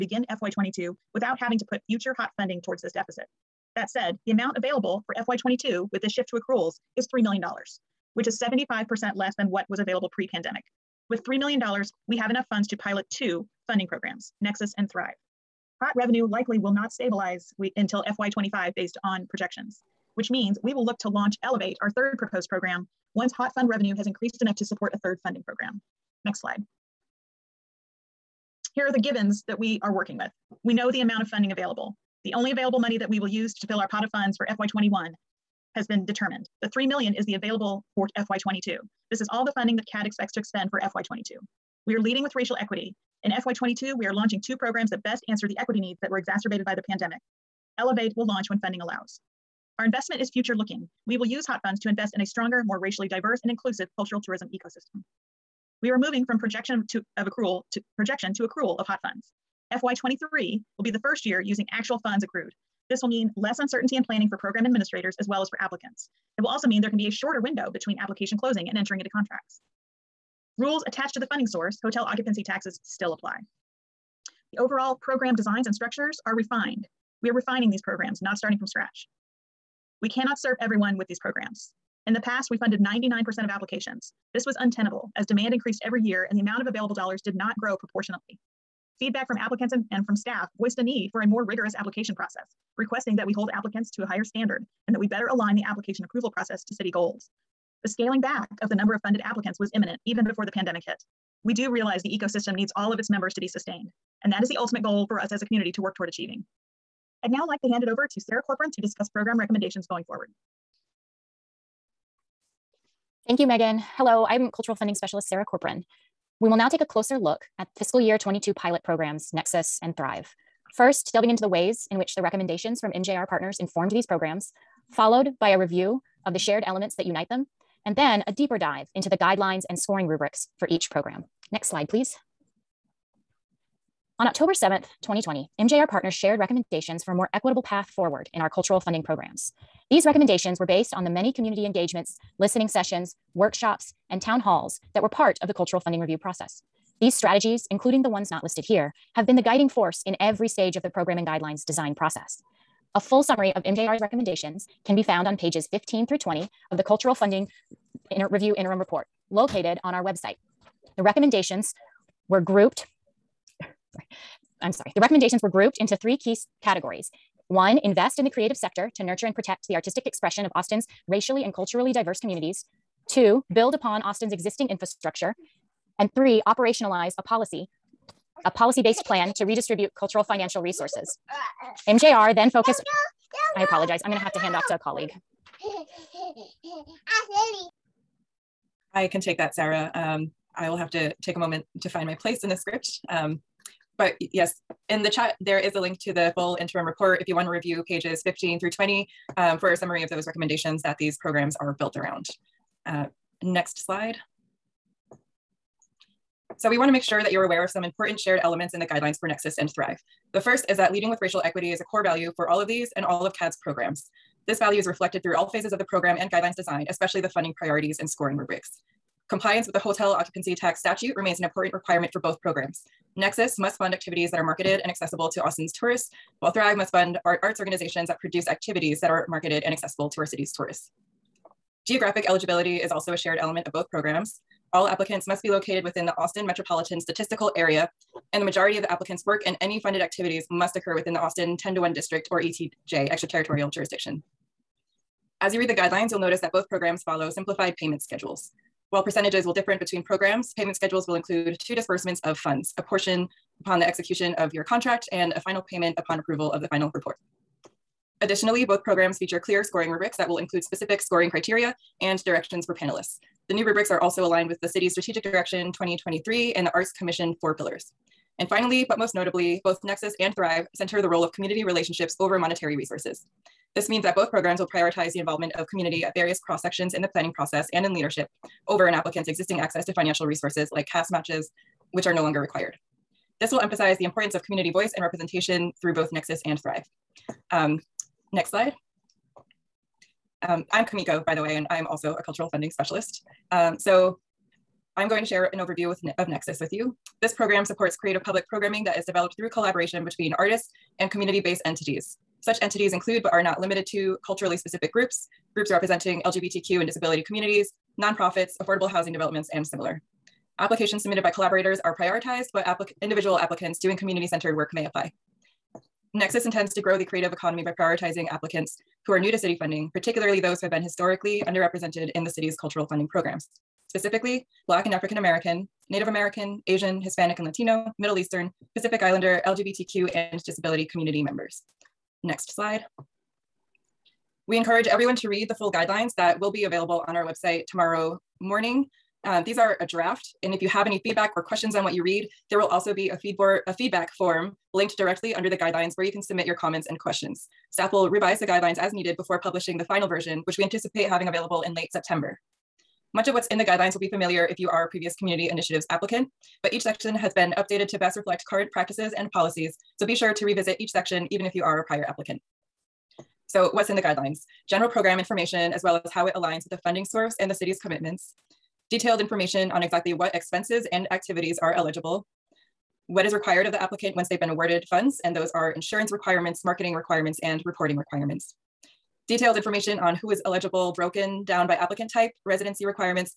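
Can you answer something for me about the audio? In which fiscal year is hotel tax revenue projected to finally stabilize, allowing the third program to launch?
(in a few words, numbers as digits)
FY25.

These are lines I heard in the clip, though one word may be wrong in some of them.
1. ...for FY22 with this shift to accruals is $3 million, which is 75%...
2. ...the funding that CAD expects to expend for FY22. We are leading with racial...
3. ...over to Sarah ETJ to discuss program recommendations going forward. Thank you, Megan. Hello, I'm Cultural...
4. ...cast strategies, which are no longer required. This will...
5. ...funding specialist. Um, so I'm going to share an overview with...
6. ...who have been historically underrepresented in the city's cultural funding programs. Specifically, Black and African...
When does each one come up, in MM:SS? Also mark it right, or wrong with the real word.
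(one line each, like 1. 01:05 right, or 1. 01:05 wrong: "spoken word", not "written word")
1. 00:05 right
2. 00:39 right
3. 01:47 wrong: "Corcoran", not "ETJ"
4. 04:40 wrong: "matches", not "strategies"
5. 04:52 right
6. 05:20 right.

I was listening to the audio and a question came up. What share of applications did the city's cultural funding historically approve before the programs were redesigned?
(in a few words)
99%.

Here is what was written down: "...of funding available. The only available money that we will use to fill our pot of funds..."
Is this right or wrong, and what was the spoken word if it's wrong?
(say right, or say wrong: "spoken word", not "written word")
right.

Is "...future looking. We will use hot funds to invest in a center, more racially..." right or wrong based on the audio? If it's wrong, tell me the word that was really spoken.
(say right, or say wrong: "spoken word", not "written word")
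wrong: "stronger", not "center".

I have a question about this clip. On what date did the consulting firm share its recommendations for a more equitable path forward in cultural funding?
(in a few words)
October 7th, 2020.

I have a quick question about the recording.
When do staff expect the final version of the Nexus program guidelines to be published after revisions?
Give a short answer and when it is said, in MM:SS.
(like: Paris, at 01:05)
late September, at 05:51.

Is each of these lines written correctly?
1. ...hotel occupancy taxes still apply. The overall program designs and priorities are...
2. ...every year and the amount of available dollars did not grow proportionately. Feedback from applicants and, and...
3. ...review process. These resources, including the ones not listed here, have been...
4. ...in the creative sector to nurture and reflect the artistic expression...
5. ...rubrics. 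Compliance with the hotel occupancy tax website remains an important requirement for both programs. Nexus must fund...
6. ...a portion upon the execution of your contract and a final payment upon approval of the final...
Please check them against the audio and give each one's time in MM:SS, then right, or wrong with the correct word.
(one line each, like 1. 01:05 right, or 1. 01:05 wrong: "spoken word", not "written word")
1. 01:11 wrong: "structures", not "priorities"
2. 01:25 right
3. 02:25 wrong: "strategies", not "resources"
4. 02:48 wrong: "protect", not "reflect"
5. 03:38 wrong: "statute", not "website"
6. 04:12 right.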